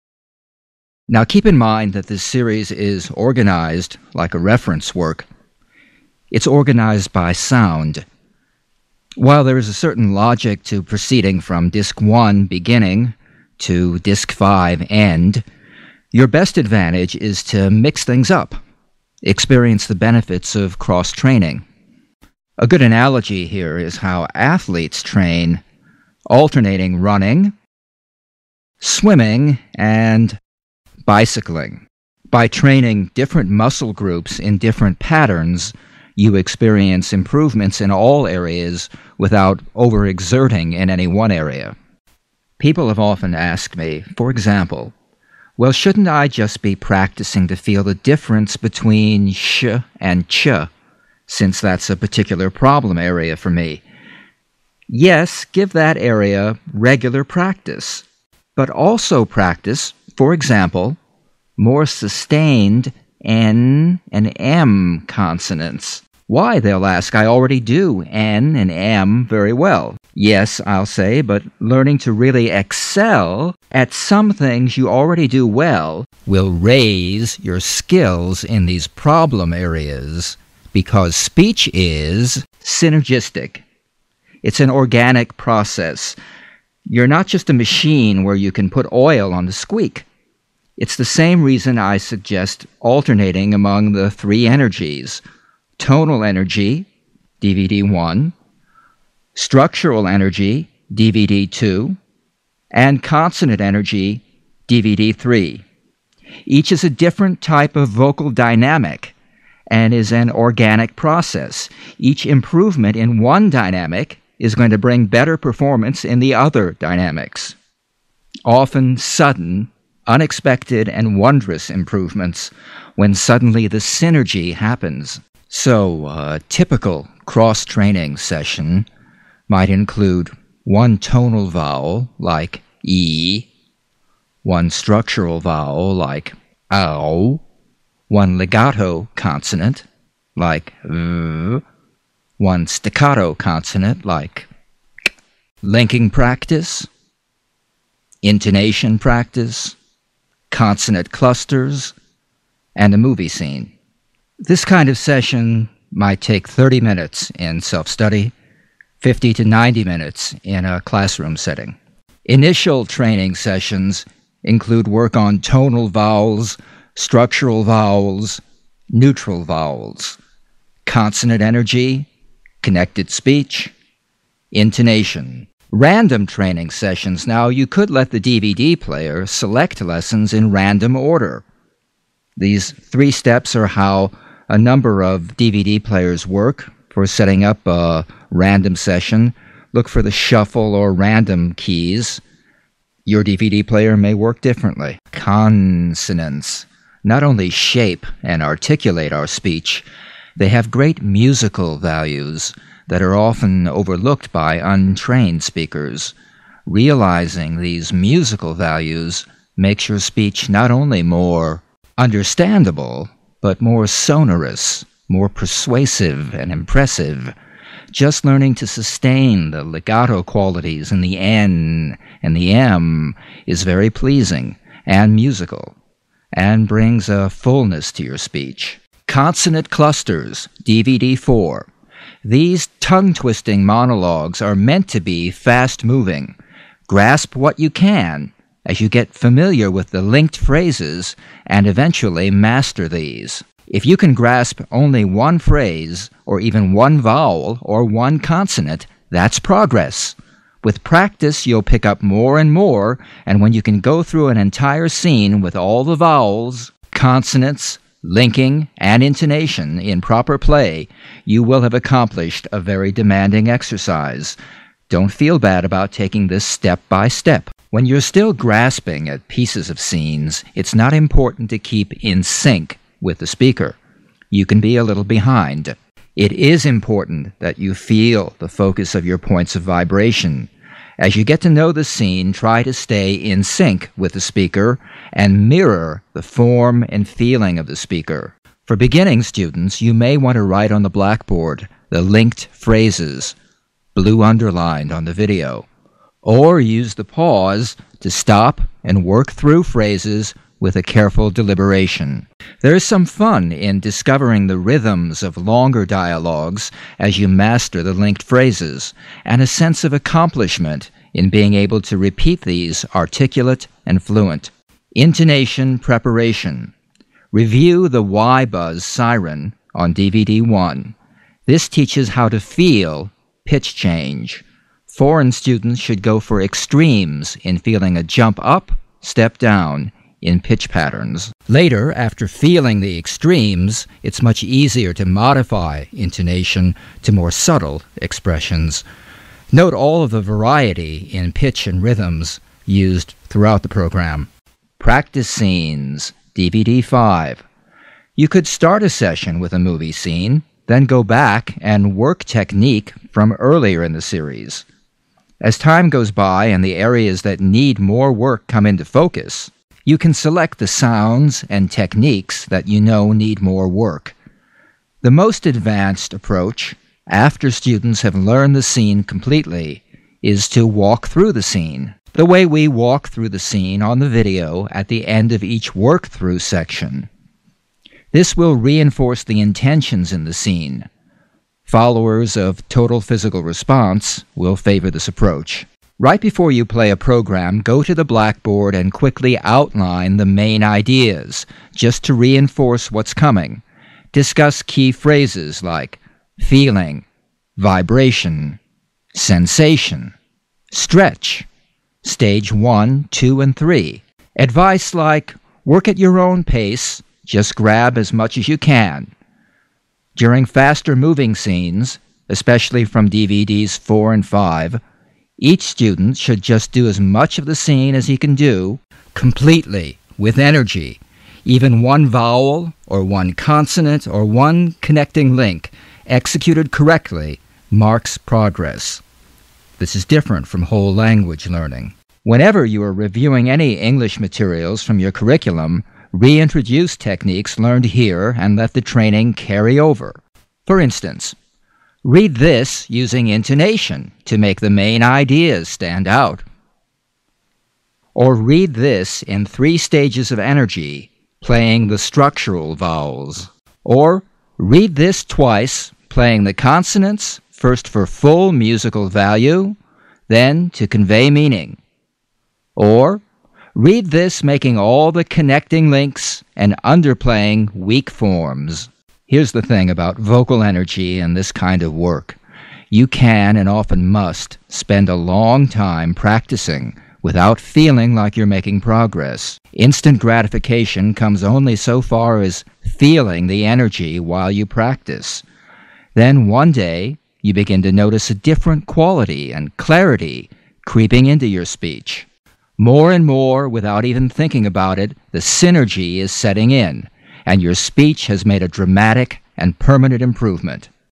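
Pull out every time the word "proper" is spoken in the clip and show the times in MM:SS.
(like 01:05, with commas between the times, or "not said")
04:20.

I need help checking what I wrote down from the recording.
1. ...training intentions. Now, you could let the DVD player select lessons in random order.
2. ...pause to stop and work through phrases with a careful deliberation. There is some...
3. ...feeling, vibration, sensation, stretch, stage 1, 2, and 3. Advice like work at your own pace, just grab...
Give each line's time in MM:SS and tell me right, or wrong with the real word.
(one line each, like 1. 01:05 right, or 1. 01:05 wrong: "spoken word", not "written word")
1. 02:56 wrong: "sessions", not "intentions"
2. 04:57 right
3. 06:36 right.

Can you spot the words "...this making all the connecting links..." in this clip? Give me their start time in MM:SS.
07:44.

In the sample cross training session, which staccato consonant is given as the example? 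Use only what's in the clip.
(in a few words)
K.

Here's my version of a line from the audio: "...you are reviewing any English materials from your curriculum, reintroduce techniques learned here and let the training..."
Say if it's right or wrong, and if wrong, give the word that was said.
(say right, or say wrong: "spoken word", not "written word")
right.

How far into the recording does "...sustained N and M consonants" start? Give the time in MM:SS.
01:01.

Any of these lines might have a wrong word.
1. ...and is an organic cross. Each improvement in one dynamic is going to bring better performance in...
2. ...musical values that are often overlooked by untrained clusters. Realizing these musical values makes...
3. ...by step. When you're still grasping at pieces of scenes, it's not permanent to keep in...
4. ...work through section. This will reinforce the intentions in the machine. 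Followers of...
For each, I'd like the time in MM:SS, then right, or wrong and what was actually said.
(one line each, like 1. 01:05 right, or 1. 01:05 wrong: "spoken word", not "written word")
1. 01:49 wrong: "process", not "cross"
2. 03:21 wrong: "speakers", not "clusters"
3. 04:26 wrong: "important", not "permanent"
4. 06:15 wrong: "scene", not "machine".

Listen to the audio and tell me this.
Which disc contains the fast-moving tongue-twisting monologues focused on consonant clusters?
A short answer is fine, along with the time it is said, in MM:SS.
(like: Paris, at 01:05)
DVD 4, at 03:50.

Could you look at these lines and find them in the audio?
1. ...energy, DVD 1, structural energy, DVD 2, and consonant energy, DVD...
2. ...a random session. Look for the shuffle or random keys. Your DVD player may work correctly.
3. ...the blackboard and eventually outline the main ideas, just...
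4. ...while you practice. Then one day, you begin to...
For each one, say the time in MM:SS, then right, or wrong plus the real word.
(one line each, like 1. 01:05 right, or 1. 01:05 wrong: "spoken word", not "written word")
1. 01:36 right
2. 03:07 wrong: "differently", not "correctly"
3. 06:27 wrong: "quickly", not "eventually"
4. 08:04 right.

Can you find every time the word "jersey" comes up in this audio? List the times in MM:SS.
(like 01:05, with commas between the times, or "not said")
not said.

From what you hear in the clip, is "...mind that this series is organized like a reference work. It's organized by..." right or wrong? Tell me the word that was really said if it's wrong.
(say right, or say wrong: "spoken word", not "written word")
right.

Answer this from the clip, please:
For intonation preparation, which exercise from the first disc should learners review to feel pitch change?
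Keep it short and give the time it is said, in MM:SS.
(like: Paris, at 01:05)
Y Buzz Siren, at 05:18.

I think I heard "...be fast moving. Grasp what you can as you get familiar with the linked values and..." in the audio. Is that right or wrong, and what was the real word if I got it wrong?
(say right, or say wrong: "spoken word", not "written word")
wrong: "phrases", not "values".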